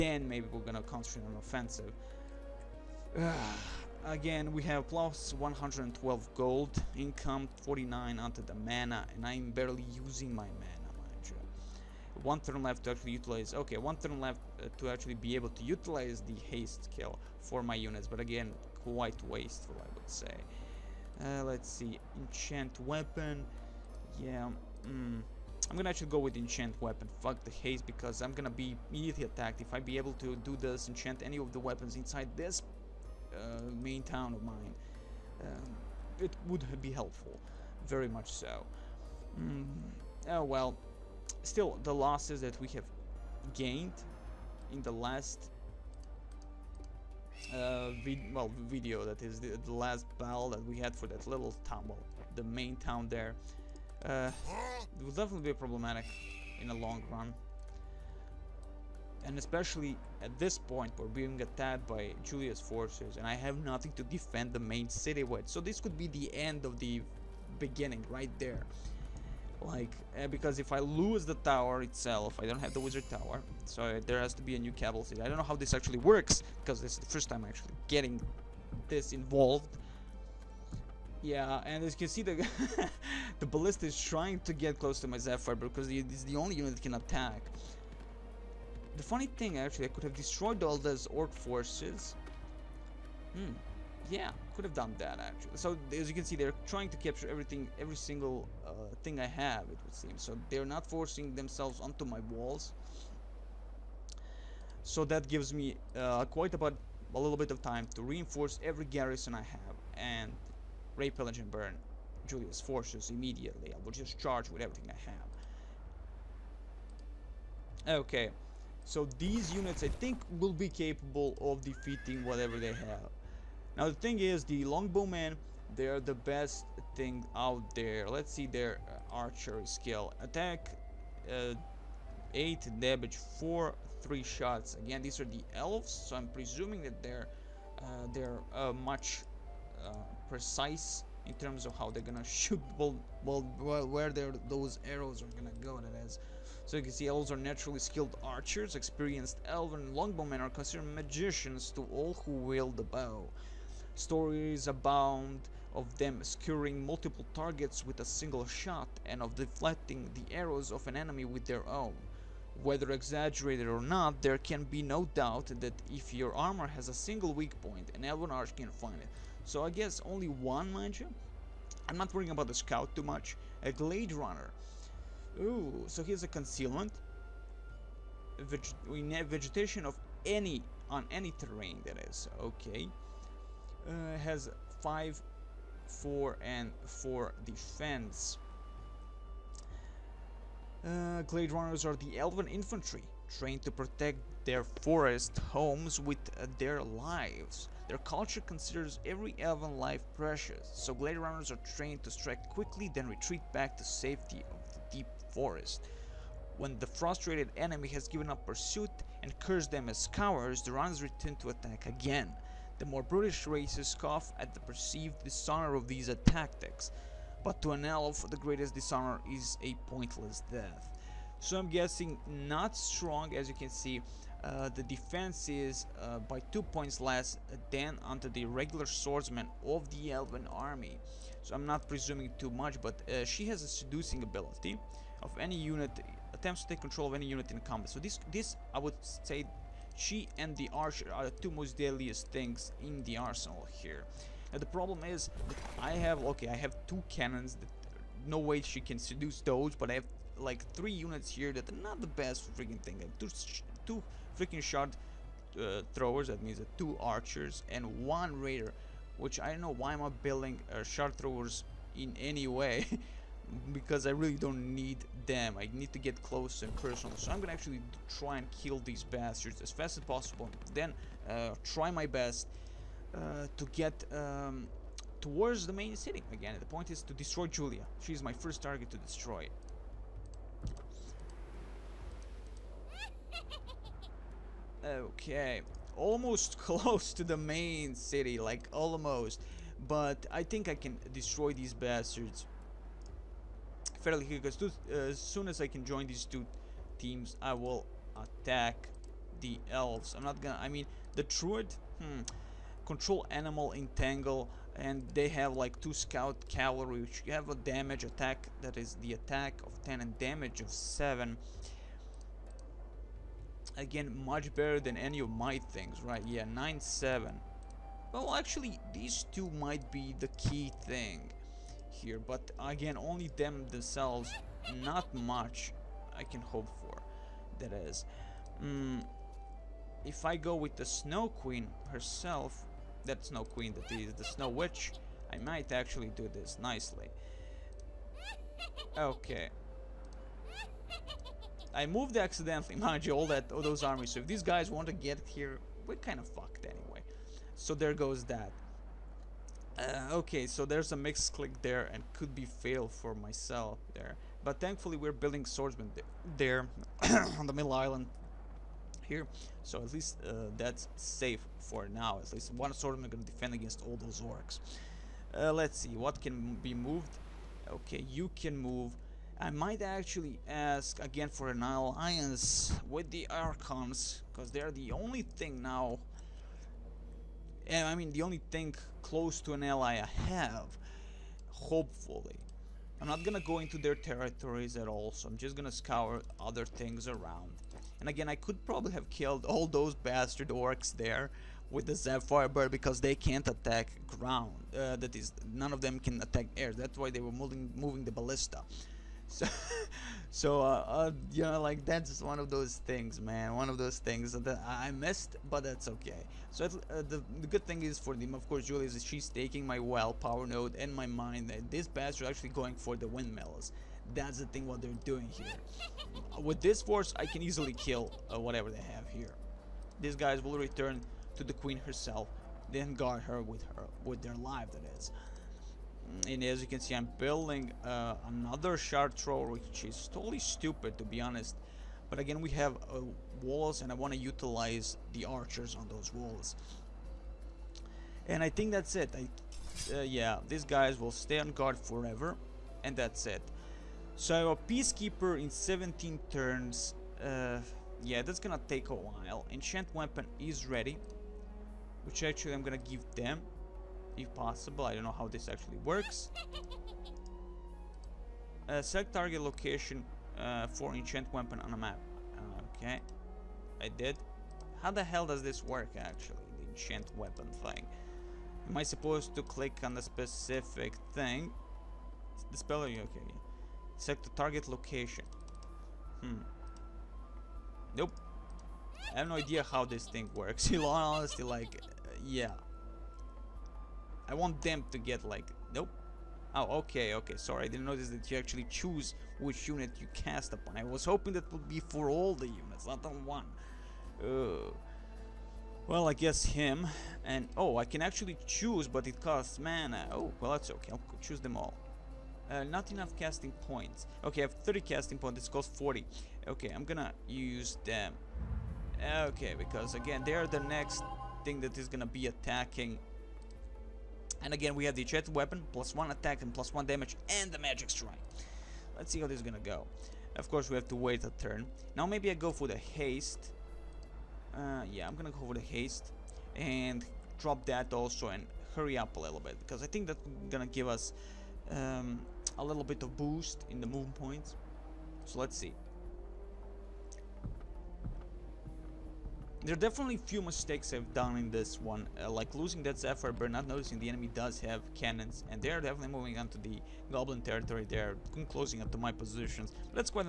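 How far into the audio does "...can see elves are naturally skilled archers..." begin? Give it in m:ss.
2:26.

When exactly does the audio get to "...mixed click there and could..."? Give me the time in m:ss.
5:50.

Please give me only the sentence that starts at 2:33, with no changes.
Stories abound of them skewering multiple targets with a single shot and of deflecting the arrows of an enemy with their own.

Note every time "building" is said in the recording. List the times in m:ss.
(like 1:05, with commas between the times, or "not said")
4:20, 5:55, 7:07.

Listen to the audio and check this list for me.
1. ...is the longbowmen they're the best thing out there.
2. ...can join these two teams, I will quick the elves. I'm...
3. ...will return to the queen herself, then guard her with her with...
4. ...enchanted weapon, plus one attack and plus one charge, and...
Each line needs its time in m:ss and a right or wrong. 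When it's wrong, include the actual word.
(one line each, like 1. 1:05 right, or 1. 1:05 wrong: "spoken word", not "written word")
1. 2:04 right
2. 4:55 wrong: "attack", not "quick"
3. 7:00 right
4. 8:35 wrong: "damage", not "charge".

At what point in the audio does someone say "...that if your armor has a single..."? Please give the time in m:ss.
2:45.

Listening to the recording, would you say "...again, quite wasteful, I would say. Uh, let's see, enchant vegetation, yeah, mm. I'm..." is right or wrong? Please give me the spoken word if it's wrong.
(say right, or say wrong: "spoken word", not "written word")
wrong: "weapon", not "vegetation".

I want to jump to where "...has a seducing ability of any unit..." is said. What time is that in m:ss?
3:53.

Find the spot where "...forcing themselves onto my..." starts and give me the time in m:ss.
1:40.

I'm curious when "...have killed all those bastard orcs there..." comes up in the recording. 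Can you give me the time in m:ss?
6:28.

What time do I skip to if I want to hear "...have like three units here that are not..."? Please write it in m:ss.
4:09.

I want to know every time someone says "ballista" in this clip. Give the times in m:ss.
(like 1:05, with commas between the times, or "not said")
1:23, 6:38.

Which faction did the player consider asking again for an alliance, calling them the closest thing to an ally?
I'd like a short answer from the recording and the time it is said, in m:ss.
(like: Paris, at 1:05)
Archons, at 6:13.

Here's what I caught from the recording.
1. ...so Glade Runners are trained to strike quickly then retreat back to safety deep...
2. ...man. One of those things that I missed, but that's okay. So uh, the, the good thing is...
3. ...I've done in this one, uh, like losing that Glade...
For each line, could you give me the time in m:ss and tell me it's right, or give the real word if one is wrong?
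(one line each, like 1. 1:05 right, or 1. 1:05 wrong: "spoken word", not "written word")
1. 3:20 right
2. 6:43 right
3. 9:00 wrong: "Zephyr", not "Glade".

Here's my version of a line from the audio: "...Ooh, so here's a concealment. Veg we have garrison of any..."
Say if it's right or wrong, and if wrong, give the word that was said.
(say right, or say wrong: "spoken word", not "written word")
wrong: "vegetation", not "garrison".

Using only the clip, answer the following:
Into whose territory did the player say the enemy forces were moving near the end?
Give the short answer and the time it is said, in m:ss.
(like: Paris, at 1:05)
Goblin territory, at 9:07.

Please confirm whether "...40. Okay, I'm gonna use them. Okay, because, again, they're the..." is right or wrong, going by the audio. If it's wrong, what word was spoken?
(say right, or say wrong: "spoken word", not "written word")
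right.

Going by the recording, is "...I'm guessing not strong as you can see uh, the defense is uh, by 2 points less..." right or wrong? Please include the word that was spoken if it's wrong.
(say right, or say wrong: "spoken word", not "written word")
right.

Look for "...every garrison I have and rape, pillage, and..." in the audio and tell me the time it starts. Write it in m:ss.
1:48.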